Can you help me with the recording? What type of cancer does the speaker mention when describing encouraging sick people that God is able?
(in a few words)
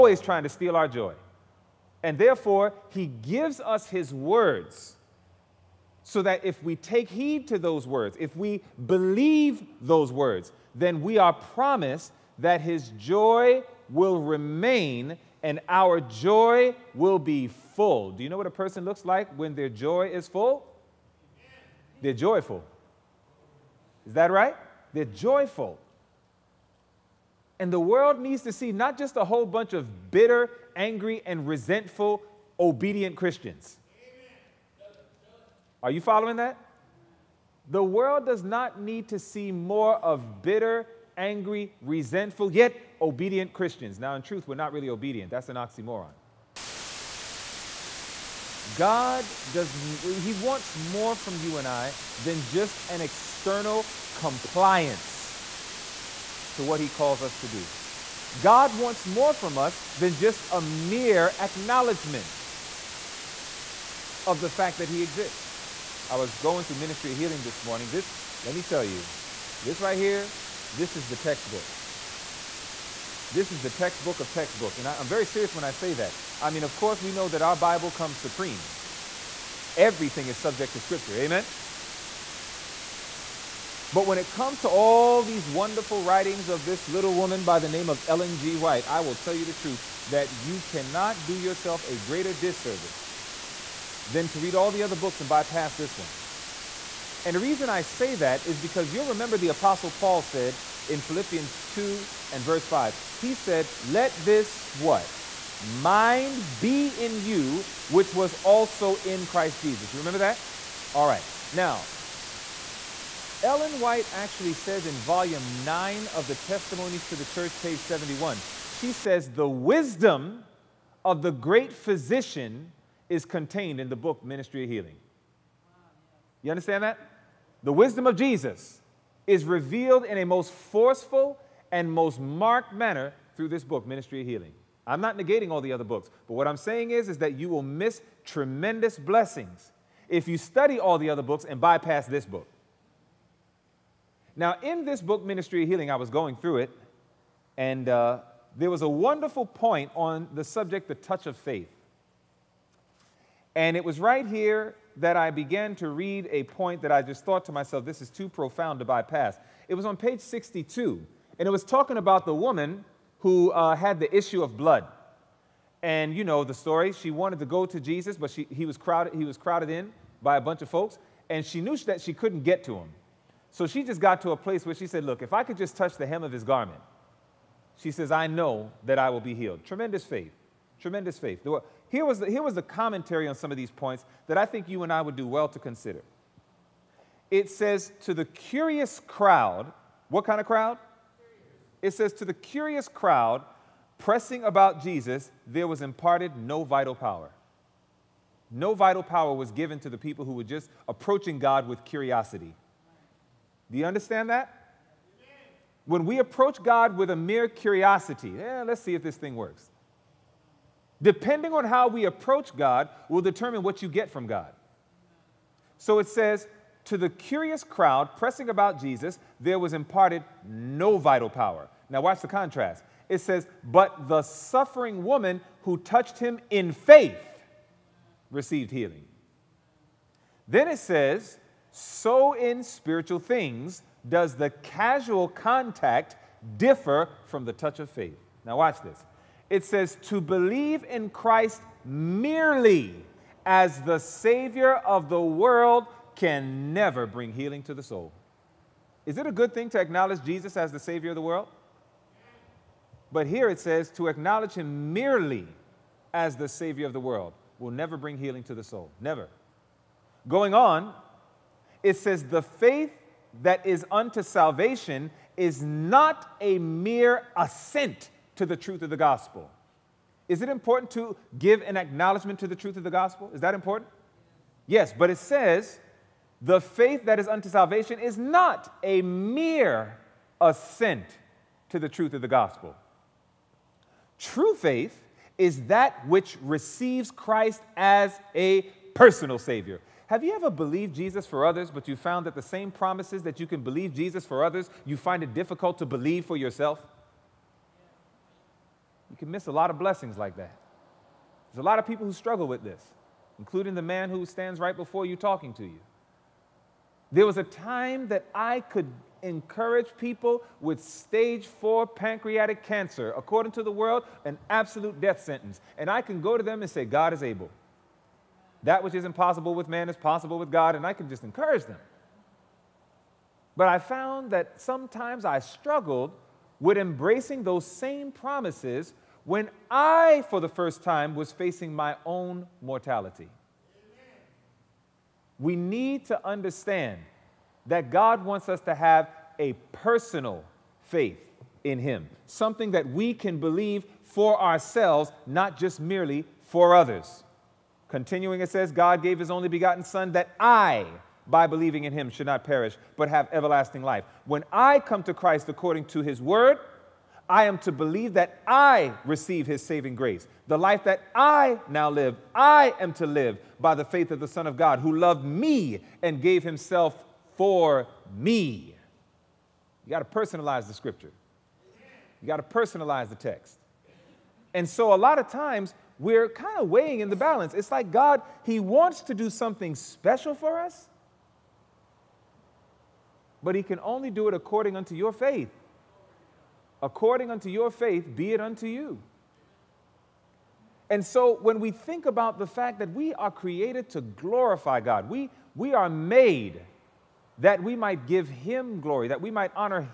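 stage four pancreatic cancer.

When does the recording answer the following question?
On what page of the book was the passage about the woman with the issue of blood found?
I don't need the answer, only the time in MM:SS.
02:39.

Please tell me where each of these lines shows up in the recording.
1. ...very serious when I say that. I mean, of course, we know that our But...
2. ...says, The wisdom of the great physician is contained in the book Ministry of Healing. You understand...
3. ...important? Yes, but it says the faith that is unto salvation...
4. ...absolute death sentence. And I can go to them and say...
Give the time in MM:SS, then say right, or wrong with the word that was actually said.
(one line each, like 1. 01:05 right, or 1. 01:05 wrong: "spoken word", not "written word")
1. 01:15 wrong: "Bible", not "But"
2. 01:58 right
3. 04:33 right
4. 05:14 right.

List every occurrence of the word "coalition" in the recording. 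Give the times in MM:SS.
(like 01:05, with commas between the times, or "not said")
not said.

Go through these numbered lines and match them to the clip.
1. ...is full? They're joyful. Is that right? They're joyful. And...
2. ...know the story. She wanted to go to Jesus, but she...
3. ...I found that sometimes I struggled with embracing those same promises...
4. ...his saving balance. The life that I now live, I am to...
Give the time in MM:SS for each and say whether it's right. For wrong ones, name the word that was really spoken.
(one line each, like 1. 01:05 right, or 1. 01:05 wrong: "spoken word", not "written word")
1. 00:20 right
2. 02:46 right
3. 05:23 right
4. 05:59 wrong: "grace", not "balance".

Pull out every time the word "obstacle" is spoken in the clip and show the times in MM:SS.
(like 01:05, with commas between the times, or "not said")
not said.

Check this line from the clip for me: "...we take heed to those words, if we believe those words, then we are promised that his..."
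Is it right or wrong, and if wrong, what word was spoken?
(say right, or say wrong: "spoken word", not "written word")
right.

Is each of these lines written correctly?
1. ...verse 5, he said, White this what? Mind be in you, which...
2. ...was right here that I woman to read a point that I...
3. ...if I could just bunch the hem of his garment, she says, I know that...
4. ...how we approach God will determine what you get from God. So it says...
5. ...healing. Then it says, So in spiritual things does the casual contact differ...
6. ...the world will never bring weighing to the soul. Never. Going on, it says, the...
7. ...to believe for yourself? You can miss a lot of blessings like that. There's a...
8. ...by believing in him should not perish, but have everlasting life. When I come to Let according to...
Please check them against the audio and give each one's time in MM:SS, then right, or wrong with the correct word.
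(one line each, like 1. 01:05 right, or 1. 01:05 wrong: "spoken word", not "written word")
1. 01:42 wrong: "Let", not "White"
2. 02:33 wrong: "began", not "woman"
3. 02:55 wrong: "touch", not "bunch"
4. 03:31 right
5. 03:48 right
6. 04:16 wrong: "healing", not "weighing"
7. 04:55 right
8. 05:51 wrong: "Christ", not "Let".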